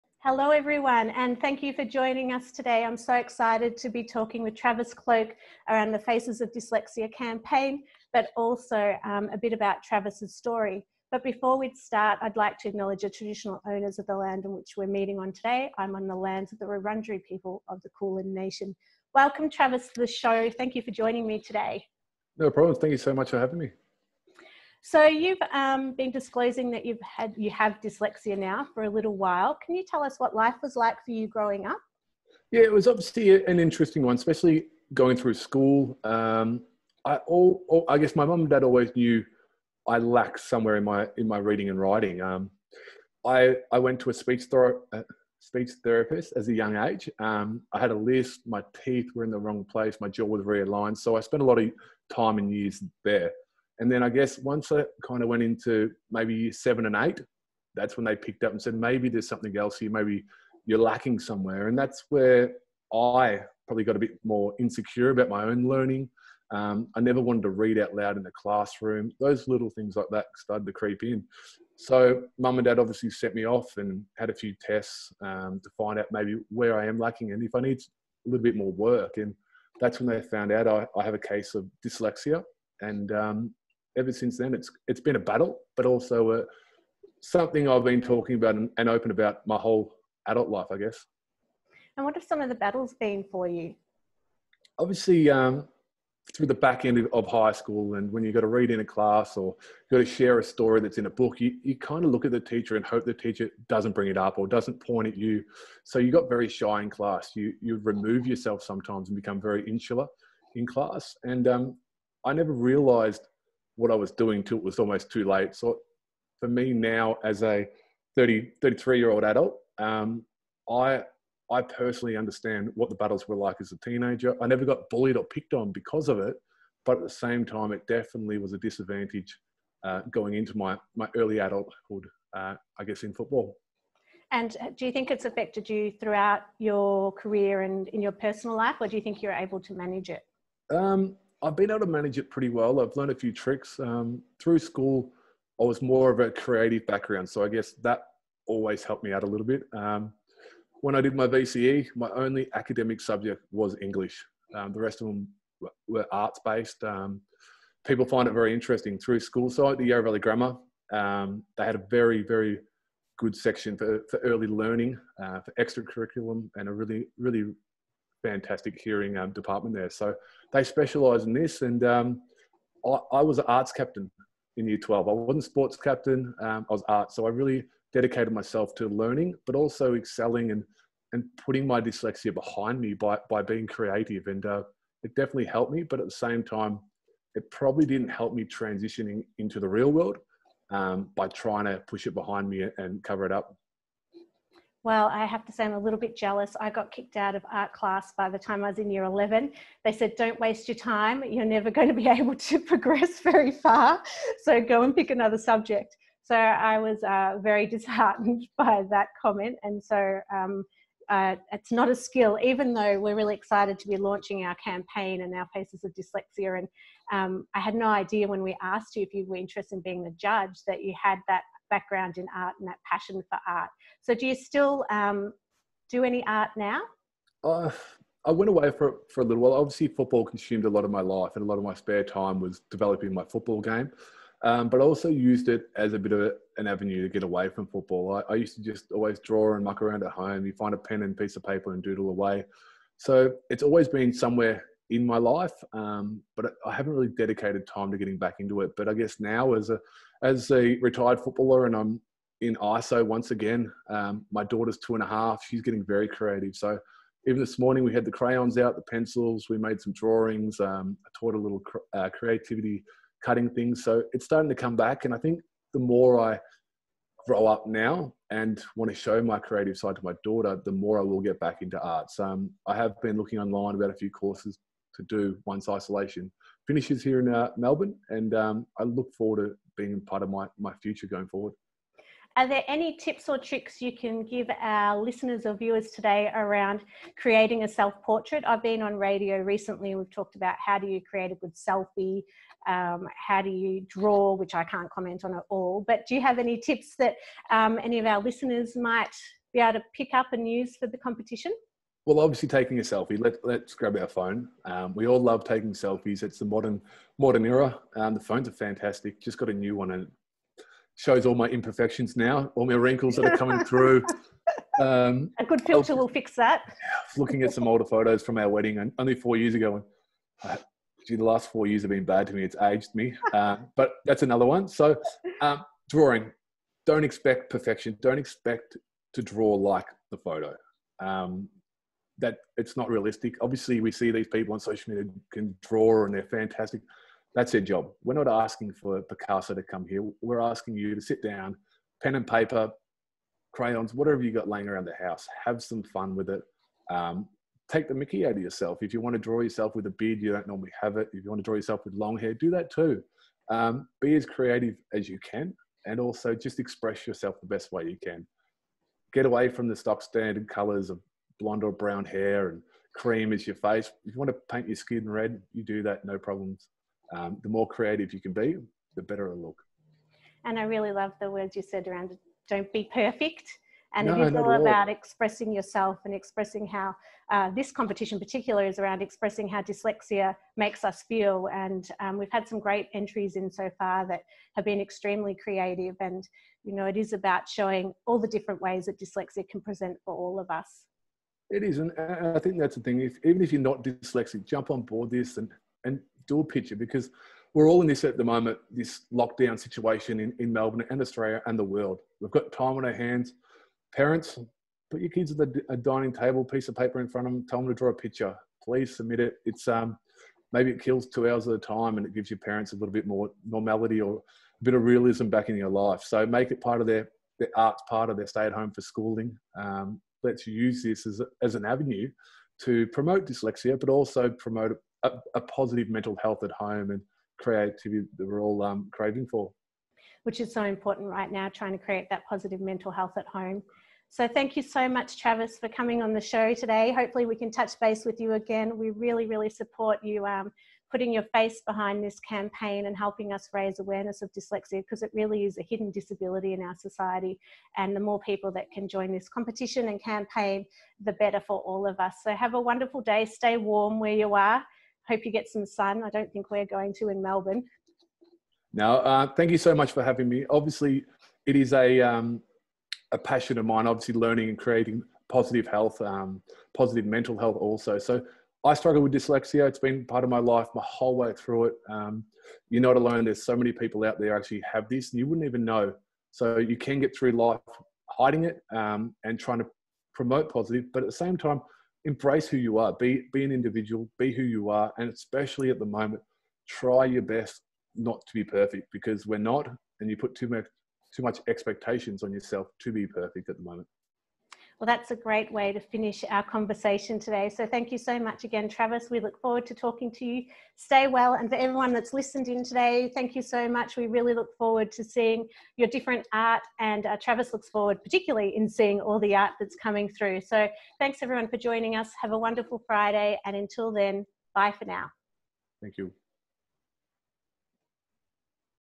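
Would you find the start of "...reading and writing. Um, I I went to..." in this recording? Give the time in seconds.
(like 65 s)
41 s.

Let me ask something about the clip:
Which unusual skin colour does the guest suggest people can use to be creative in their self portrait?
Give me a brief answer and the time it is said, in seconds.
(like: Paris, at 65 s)
red, at 365 s.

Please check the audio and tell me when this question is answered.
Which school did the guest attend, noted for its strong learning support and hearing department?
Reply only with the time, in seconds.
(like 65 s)
159 s.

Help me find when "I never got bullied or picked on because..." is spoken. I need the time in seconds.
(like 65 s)
124 s.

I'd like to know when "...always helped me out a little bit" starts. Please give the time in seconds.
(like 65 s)
148 s.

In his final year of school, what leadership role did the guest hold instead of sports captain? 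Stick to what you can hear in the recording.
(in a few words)
arts captain.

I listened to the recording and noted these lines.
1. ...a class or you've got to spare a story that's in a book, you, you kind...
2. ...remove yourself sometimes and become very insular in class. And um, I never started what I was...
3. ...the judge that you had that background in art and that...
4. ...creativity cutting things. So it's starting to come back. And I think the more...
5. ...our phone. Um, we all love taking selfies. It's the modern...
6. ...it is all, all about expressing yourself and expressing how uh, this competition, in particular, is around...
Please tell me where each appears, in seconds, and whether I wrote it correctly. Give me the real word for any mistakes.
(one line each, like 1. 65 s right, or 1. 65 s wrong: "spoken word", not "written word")
1. 98 s wrong: "share", not "spare"
2. 107 s wrong: "realized", not "started"
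3. 220 s right
4. 262 s right
5. 303 s right
6. 374 s right.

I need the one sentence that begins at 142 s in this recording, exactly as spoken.
I've learned a few tricks um, through school.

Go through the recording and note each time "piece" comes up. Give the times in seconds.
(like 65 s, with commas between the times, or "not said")
241 s, 406 s.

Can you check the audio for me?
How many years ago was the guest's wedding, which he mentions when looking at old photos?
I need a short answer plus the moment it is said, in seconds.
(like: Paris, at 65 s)
4, at 319 s.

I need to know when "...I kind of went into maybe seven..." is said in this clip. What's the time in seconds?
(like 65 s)
54 s.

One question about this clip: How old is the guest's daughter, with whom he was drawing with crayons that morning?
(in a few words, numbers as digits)
2 and a half.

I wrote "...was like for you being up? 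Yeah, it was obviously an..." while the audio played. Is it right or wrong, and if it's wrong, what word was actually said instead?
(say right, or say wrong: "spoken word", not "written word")
wrong: "growing", not "being".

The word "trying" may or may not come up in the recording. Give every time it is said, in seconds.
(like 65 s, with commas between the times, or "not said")
191 s, 431 s, 479 s.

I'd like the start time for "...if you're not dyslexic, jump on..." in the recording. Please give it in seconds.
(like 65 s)
393 s.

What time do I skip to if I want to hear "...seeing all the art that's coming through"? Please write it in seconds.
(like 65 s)
508 s.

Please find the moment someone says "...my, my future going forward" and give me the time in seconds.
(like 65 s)
280 s.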